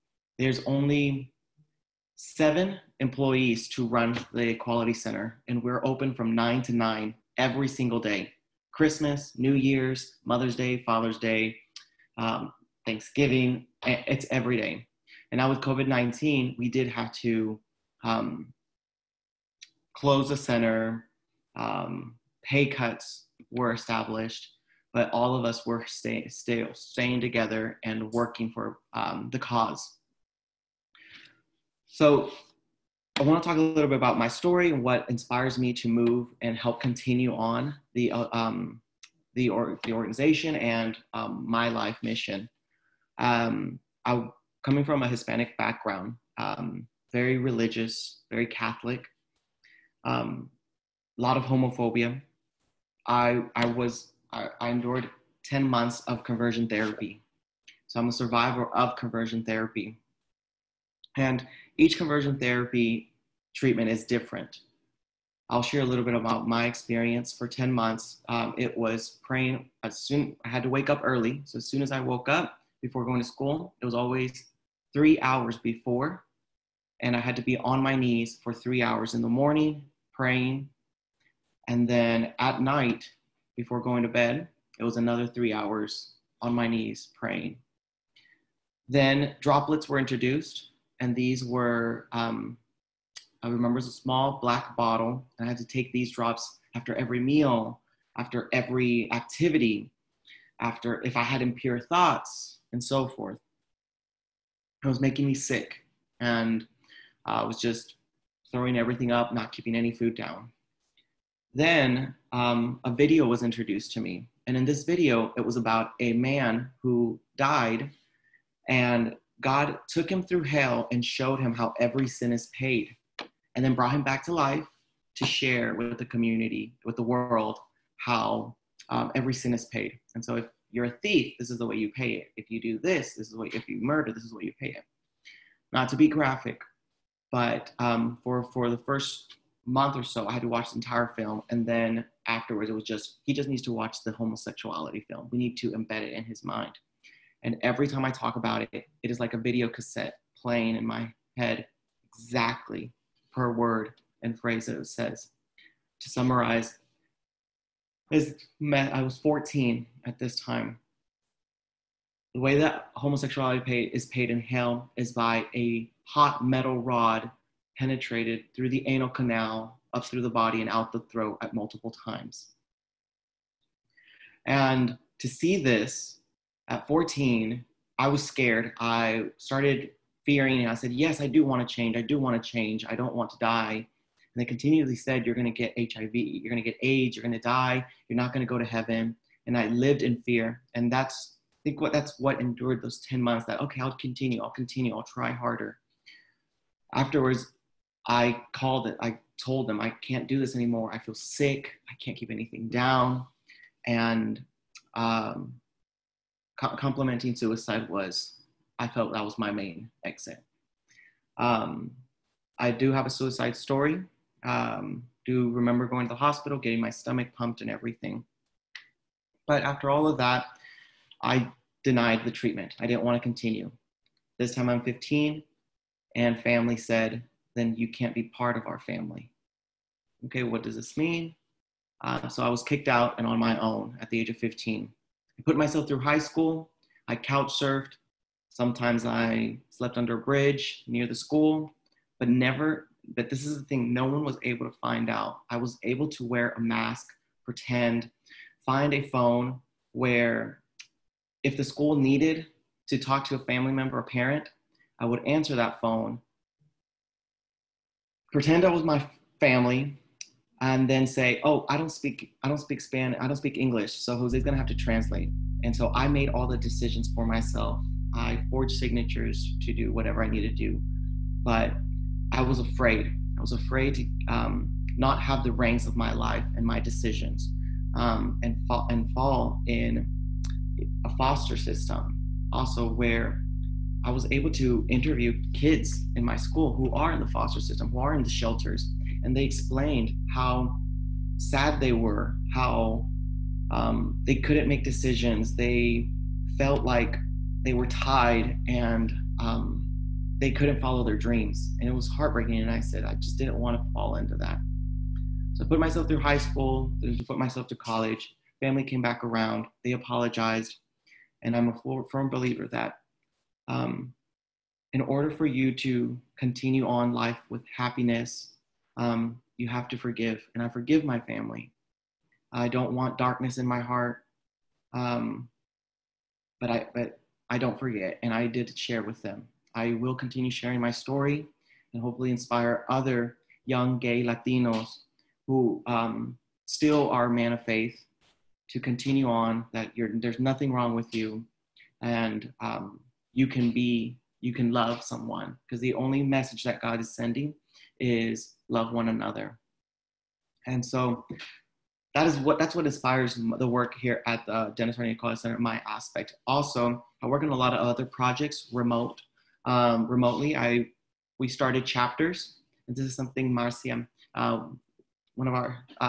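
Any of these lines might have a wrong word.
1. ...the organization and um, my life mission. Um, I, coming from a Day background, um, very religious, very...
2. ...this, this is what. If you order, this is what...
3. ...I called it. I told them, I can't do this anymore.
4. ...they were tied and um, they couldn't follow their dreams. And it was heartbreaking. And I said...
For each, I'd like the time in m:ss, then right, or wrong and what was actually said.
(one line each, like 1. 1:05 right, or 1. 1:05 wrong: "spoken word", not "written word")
1. 0:39 wrong: "Hispanic", not "Day"
2. 2:12 wrong: "murder", not "order"
3. 3:18 right
4. 4:57 right.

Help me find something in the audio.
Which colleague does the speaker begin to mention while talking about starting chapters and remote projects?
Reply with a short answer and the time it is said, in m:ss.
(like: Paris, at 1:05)
Marcia, at 6:03.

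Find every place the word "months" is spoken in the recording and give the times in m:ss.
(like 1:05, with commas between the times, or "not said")
0:55, 1:07, 2:19, 3:13.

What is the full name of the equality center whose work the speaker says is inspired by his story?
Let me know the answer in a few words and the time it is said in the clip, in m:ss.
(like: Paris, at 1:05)
Dennis R. Neill Equality Center, at 5:54.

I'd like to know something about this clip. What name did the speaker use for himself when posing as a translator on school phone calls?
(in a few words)
Jose.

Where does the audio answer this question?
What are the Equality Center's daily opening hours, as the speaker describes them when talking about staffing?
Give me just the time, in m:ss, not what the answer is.
0:06.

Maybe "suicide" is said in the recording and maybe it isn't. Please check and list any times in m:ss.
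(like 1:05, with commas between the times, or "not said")
3:27, 3:33.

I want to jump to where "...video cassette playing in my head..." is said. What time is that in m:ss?
2:29.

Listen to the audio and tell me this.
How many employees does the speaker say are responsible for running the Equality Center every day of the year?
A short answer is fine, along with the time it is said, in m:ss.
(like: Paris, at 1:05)
7, at 0:02.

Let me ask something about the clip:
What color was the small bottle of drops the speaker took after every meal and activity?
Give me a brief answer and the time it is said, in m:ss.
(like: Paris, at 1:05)
Black, at 1:34.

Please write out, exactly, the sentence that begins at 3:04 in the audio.
And they continually said, You're going to get HIV.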